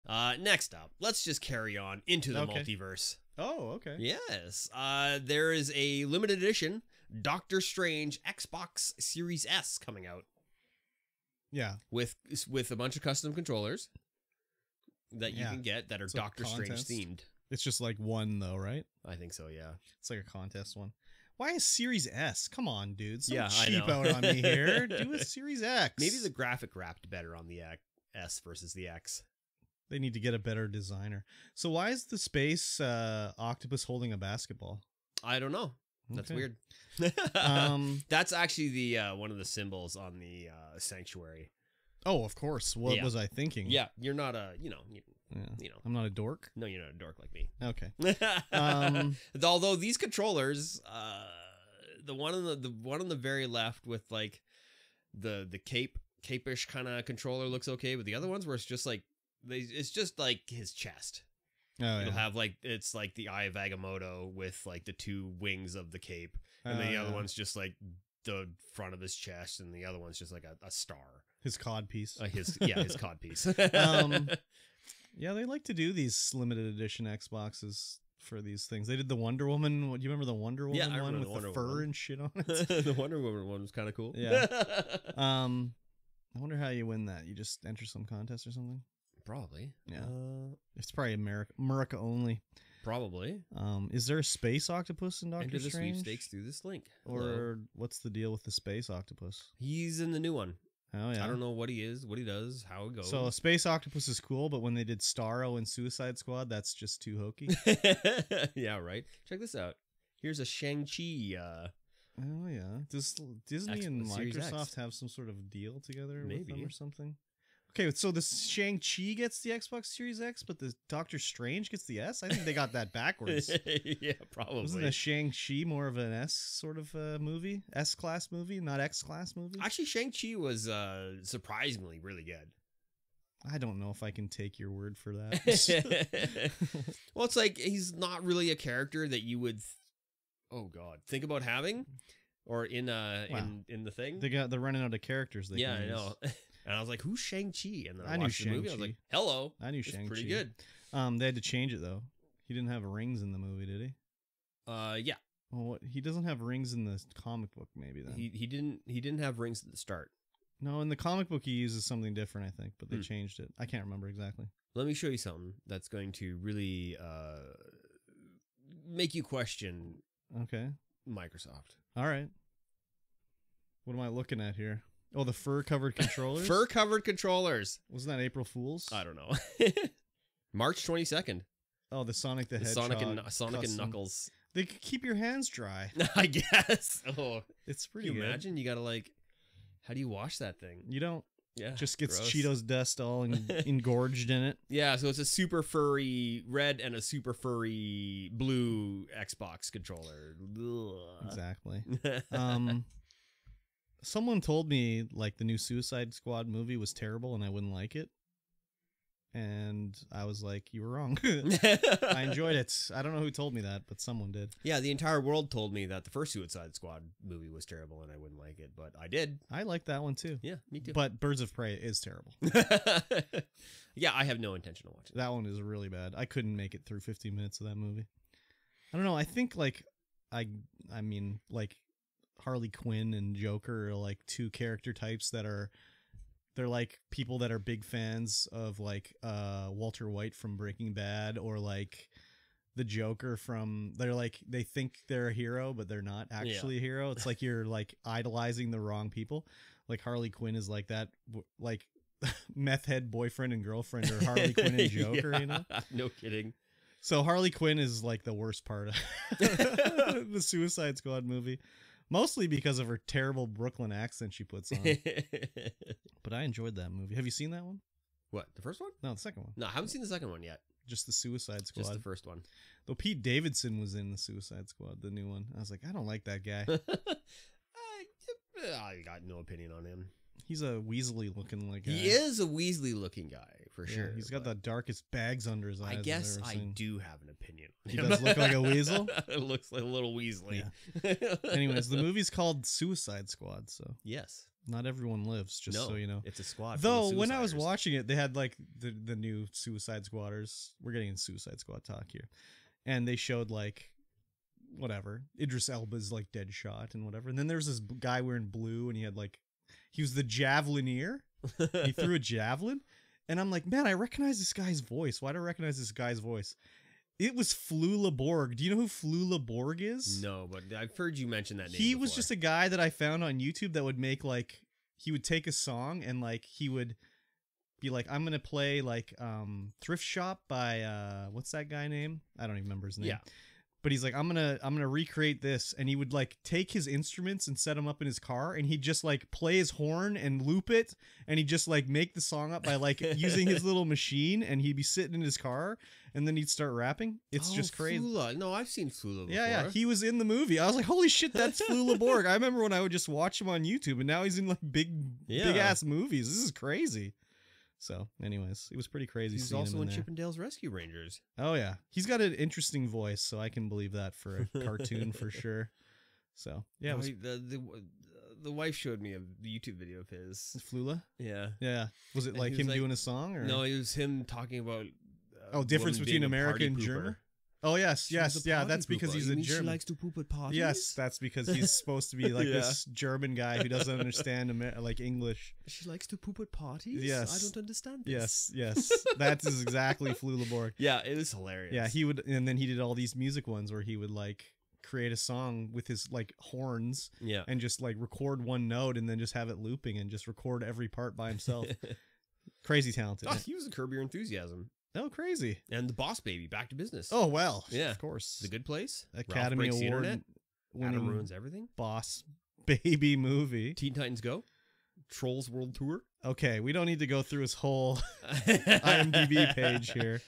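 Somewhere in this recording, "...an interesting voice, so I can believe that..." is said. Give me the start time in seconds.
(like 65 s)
362 s.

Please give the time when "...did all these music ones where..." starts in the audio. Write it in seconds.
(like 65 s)
392 s.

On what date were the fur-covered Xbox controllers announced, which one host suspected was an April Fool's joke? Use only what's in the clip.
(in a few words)
March 22nd.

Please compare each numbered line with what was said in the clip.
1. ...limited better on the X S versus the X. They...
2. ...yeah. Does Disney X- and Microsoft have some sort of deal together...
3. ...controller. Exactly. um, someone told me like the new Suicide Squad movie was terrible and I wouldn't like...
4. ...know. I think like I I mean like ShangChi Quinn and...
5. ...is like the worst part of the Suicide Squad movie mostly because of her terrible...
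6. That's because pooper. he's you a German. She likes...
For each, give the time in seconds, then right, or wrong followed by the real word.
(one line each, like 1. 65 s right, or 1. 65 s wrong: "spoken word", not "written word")
1. 26 s wrong: "wrapped", not "limited"
2. 112 s right
3. 199 s right
4. 229 s wrong: "Harley", not "ShangChi"
5. 257 s right
6. 378 s right.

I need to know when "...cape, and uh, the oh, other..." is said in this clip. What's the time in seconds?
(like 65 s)
65 s.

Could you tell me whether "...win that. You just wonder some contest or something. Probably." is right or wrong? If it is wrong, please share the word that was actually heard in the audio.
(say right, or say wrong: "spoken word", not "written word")
wrong: "enter", not "wonder".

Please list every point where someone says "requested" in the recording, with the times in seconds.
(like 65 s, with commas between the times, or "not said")
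not said.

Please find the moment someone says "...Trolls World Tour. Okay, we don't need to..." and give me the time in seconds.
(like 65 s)
415 s.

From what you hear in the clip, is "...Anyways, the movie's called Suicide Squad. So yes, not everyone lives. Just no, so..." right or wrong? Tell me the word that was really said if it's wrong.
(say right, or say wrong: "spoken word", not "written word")
right.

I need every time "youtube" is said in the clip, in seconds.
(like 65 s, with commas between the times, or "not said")
323 s, 353 s, 369 s.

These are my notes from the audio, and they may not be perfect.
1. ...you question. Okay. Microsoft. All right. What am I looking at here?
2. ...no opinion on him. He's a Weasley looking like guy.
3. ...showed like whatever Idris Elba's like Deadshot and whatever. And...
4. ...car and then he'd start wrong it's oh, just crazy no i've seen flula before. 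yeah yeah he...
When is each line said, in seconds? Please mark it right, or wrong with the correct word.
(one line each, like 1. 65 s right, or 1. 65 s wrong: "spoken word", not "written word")
1. 169 s right
2. 279 s right
3. 303 s right
4. 345 s wrong: "rapping", not "wrong".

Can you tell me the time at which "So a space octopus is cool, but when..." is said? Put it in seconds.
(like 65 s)
103 s.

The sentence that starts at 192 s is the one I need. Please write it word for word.
Cheetos dust all en engorged in it.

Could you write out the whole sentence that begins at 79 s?
Do you remember the Wonder Woman yeah, one with the, the fur Woman.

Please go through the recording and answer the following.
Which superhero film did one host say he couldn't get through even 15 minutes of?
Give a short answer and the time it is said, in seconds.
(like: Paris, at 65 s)
Birds of Prey, at 221 s.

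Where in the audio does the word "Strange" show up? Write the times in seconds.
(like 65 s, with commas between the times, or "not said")
7 s, 16 s, 95 s, 121 s.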